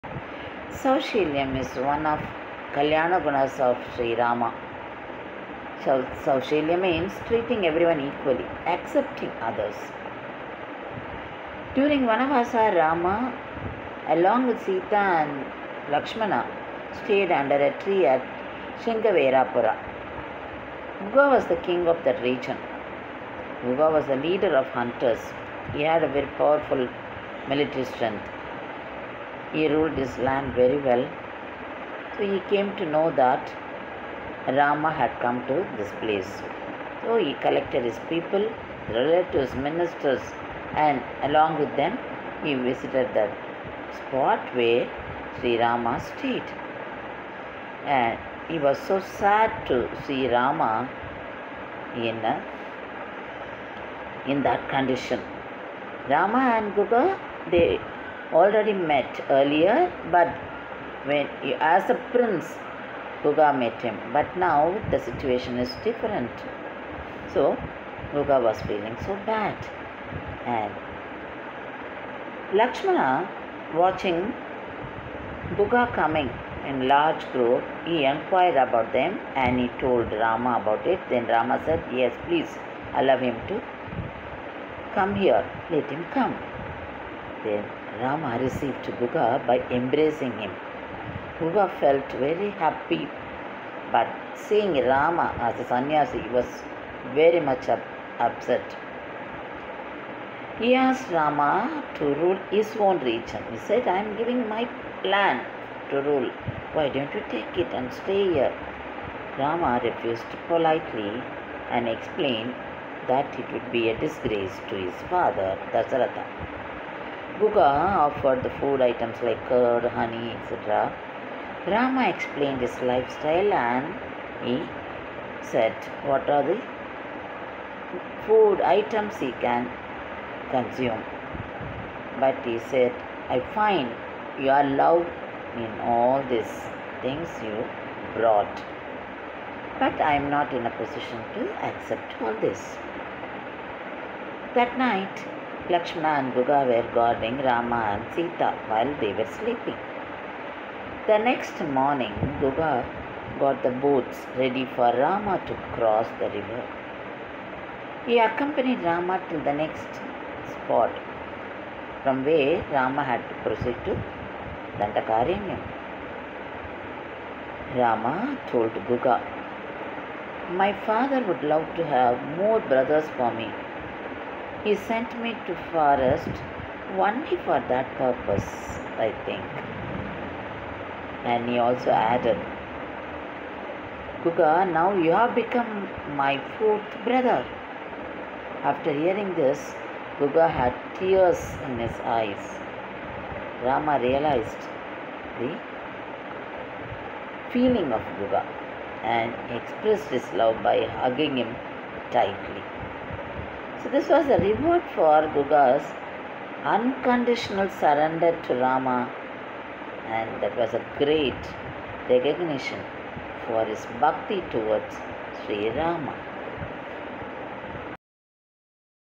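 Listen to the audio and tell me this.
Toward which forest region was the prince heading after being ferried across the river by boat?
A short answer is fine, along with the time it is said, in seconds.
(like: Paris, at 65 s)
Dandakaranam, at 164 s.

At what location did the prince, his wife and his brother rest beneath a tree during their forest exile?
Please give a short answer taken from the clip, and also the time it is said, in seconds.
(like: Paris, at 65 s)
Shingaverapura, at 18 s.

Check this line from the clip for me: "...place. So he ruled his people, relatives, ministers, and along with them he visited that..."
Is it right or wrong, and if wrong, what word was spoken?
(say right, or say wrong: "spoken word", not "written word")
wrong: "collected", not "ruled".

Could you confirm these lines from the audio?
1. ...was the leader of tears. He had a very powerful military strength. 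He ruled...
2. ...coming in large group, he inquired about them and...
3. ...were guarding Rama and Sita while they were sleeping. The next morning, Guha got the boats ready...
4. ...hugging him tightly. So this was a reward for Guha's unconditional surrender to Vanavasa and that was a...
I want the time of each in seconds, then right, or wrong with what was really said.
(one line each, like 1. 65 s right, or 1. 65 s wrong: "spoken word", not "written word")
1. 23 s wrong: "hunters", not "tears"
2. 75 s right
3. 146 s right
4. 200 s wrong: "Rama", not "Vanavasa".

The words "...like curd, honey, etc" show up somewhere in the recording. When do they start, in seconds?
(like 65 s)
119 s.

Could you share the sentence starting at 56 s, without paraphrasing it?
Rama and Guha, they already met earlier, but when as a prince, Guha met him.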